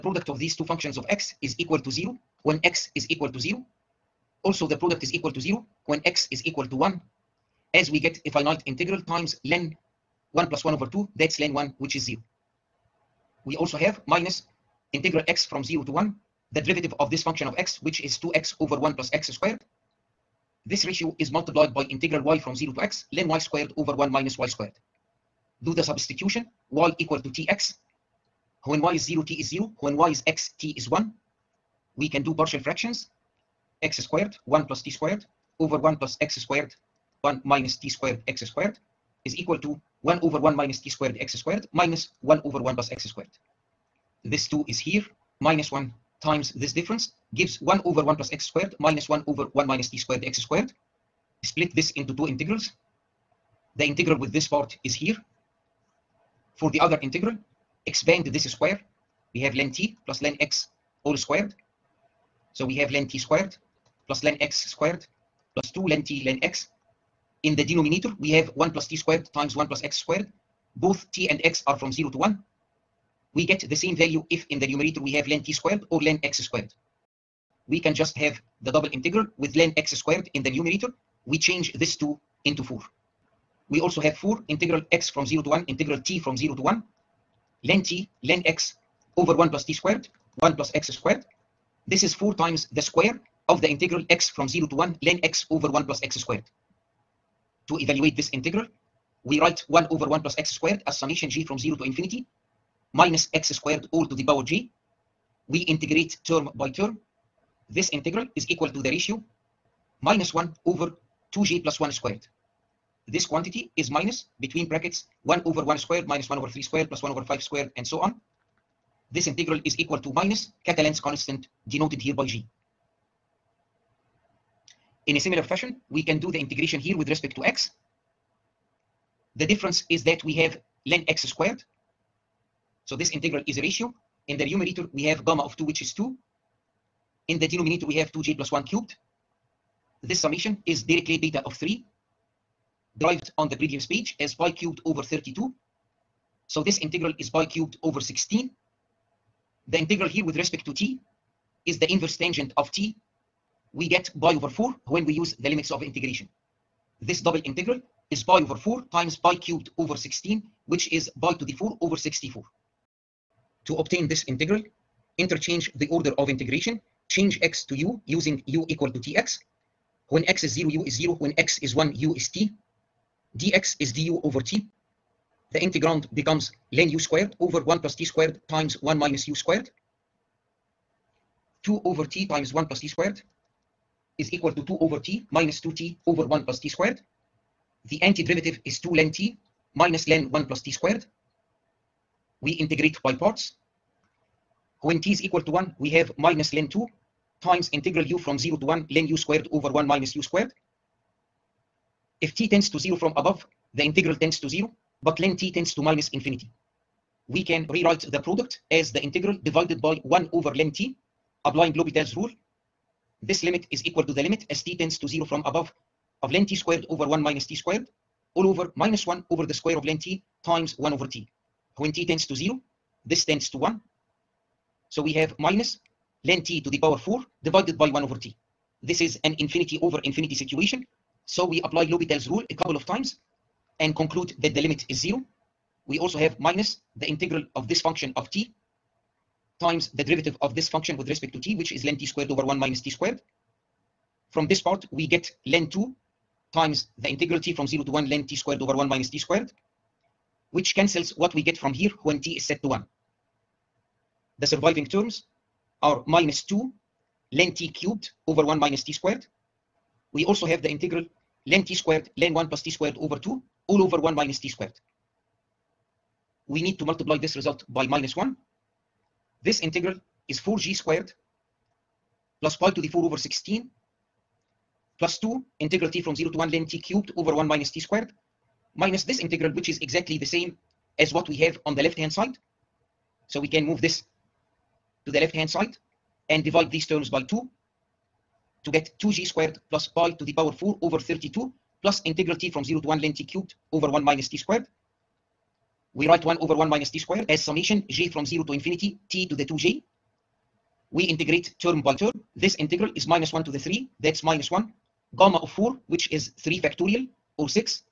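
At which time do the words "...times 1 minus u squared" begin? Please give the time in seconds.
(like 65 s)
178 s.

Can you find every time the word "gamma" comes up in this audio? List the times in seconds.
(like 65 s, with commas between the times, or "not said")
135 s, 305 s.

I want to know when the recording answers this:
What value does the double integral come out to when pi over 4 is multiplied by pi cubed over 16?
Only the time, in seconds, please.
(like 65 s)
161 s.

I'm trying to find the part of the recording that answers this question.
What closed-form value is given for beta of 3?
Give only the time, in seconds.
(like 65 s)
144 s.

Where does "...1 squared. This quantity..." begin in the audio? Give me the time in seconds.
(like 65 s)
111 s.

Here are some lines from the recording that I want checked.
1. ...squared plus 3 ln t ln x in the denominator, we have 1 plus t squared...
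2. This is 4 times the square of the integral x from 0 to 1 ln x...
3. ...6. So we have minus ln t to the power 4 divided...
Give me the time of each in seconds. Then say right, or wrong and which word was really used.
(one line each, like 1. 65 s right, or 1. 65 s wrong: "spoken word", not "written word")
1. 64 s wrong: "2", not "3"
2. 91 s right
3. 223 s wrong: "1", not "6".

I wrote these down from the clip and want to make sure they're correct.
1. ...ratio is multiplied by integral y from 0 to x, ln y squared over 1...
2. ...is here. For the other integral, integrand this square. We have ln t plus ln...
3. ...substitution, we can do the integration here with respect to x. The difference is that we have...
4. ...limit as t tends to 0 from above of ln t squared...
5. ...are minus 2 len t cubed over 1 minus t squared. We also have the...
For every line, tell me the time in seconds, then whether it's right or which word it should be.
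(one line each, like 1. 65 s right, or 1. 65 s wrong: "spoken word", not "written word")
1. 20 s right
2. 54 s wrong: "expand", not "integrand"
3. 125 s wrong: "fashion", not "substitution"
4. 214 s right
5. 255 s right.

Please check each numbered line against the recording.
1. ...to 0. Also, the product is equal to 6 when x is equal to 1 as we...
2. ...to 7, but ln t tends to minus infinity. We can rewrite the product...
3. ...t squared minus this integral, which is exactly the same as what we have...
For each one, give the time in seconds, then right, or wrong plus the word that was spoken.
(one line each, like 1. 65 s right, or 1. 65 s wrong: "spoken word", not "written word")
1. 3 s wrong: "0", not "6"
2. 204 s wrong: "0", not "7"
3. 277 s right.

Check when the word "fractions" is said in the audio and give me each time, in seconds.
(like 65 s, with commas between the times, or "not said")
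32 s.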